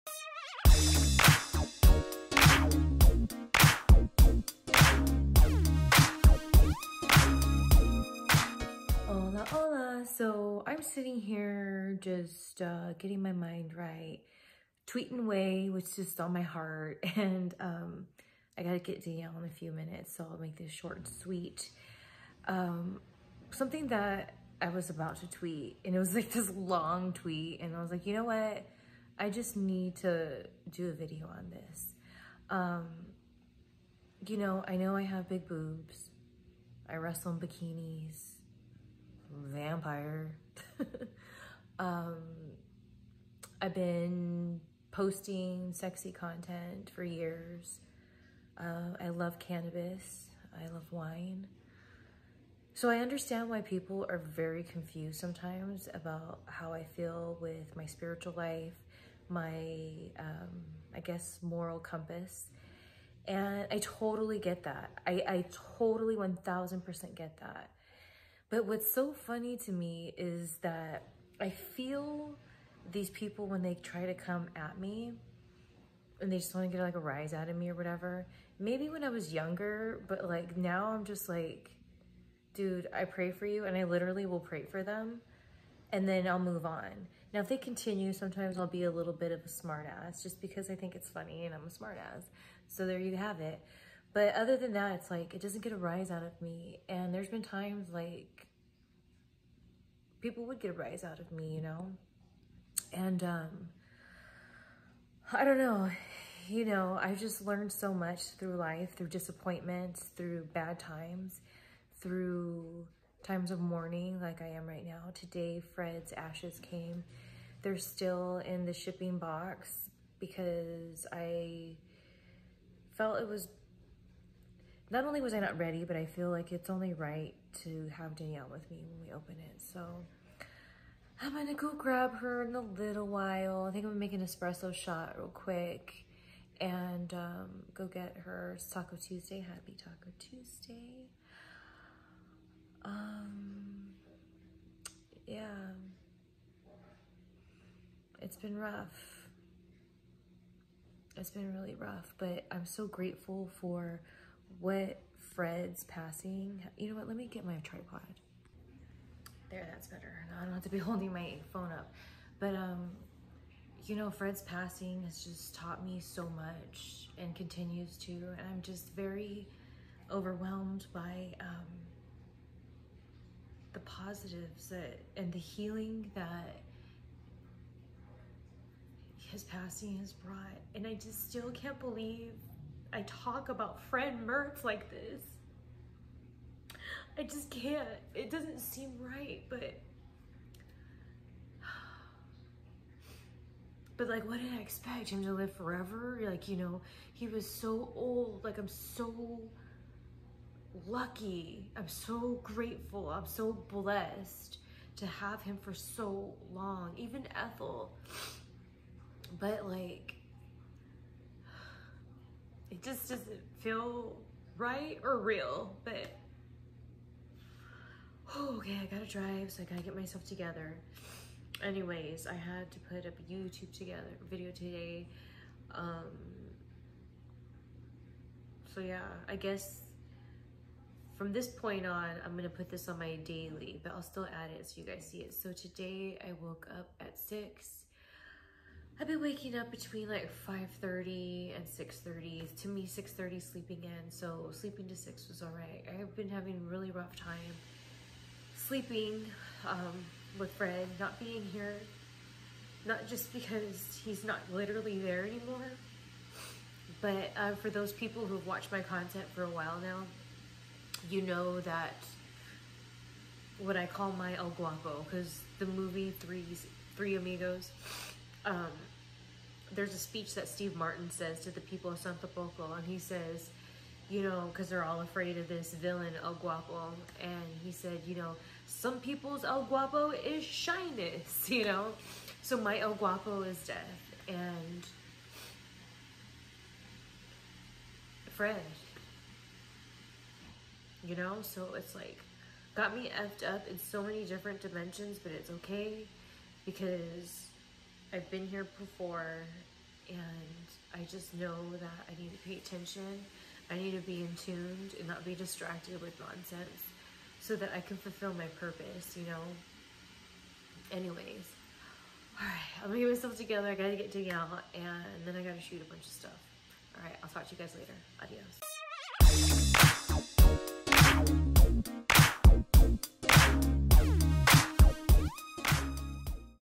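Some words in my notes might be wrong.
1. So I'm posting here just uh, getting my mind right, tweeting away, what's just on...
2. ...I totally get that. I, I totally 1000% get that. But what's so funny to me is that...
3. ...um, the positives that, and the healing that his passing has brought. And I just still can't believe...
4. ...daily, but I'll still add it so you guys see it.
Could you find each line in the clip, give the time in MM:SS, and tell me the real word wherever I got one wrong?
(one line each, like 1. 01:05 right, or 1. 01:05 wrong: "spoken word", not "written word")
1. 00:10 wrong: "sitting", not "posting"
2. 01:03 right
3. 02:51 right
4. 03:53 right.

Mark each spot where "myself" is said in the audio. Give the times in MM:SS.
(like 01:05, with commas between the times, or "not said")
03:39, 05:13.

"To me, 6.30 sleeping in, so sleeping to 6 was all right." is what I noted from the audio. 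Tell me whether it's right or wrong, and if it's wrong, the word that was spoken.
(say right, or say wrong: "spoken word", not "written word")
right.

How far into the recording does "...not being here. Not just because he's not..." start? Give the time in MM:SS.
04:10.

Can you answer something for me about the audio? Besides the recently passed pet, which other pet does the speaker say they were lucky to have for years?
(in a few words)
Ethel.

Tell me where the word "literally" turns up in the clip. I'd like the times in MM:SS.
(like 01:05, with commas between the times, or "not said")
01:23, 04:14.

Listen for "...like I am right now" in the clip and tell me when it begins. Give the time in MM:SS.
01:54.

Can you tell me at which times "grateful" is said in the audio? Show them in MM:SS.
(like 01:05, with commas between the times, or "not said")
02:32, 03:22.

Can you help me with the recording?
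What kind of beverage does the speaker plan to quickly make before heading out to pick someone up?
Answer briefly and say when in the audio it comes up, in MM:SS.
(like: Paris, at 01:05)
Espresso shot, at 02:14.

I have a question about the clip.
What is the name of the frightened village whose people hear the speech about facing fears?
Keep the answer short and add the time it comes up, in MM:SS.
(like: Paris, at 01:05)
Santa Poco, at 04:31.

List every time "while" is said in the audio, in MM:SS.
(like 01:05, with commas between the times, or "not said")
02:13, 04:19.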